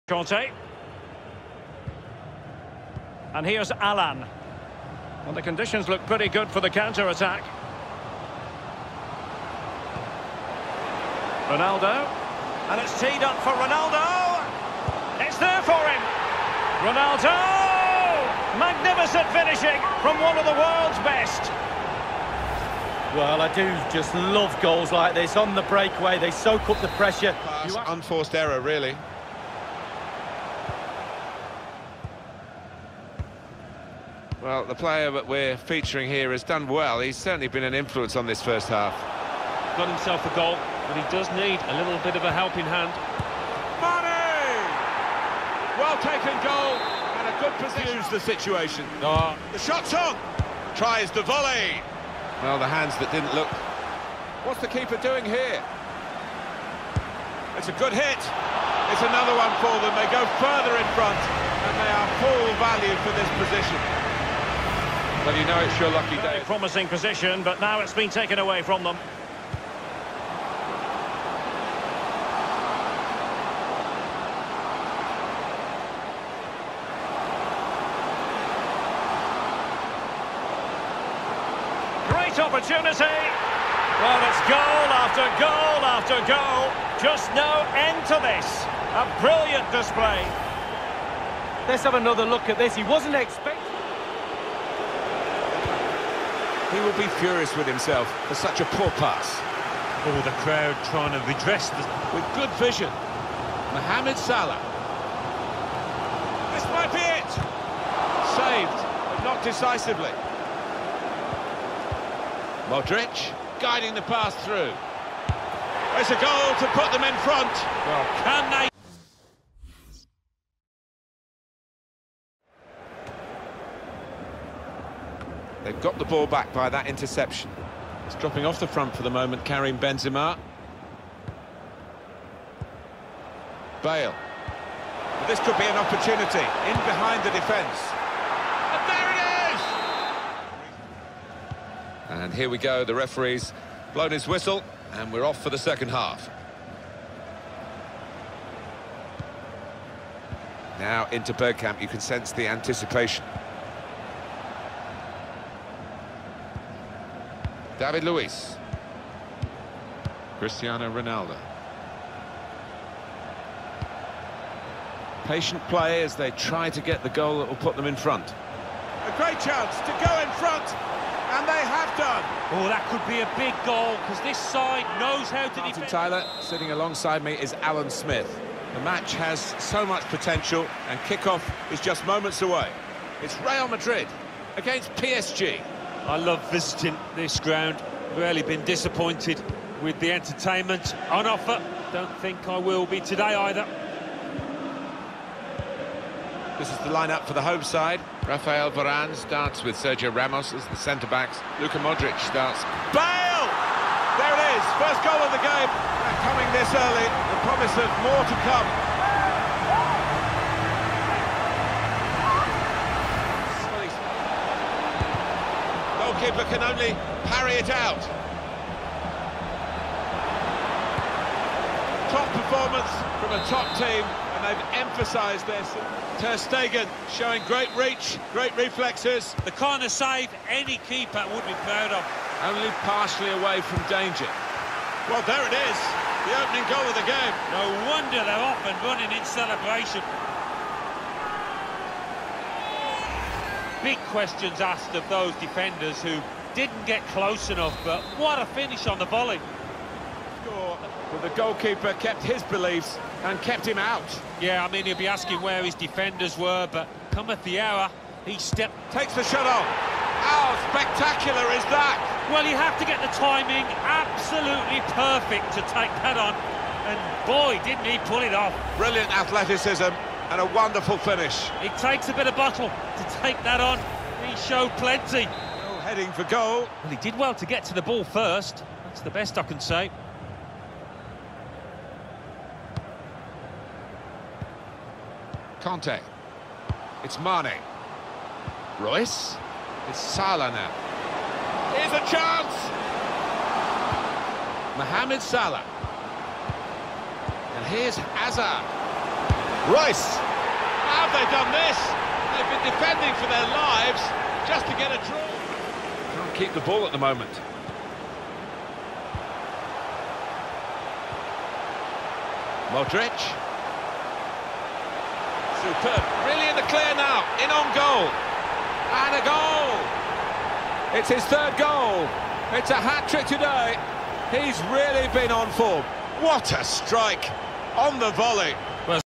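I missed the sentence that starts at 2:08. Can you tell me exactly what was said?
It's dropping off the front for the moment, Karim Benzema.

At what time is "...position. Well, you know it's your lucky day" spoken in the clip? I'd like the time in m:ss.
1:03.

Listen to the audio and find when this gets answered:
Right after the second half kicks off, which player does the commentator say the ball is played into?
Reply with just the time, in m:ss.
2:31.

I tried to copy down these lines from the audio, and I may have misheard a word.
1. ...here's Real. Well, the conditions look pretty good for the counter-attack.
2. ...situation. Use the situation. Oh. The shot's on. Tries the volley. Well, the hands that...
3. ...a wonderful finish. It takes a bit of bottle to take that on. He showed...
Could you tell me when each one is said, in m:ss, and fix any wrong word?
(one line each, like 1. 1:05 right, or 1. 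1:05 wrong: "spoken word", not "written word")
1. 0:03 wrong: "Alan", not "Real"
2. 0:47 wrong: "position", not "situation"
3. 4:30 right.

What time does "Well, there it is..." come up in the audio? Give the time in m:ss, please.
3:55.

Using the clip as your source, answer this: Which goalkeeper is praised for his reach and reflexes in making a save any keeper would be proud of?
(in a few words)
Ter Stegen.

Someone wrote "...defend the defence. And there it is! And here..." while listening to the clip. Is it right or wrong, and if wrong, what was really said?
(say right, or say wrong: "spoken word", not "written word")
wrong: "behind", not "defend".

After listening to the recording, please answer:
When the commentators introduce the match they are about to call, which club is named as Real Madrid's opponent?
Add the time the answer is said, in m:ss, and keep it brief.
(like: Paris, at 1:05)
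PSG, at 3:04.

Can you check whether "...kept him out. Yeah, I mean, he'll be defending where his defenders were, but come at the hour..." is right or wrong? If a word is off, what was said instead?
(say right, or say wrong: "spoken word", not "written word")
wrong: "asking", not "defending".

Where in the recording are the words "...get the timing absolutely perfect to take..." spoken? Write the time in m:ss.
4:22.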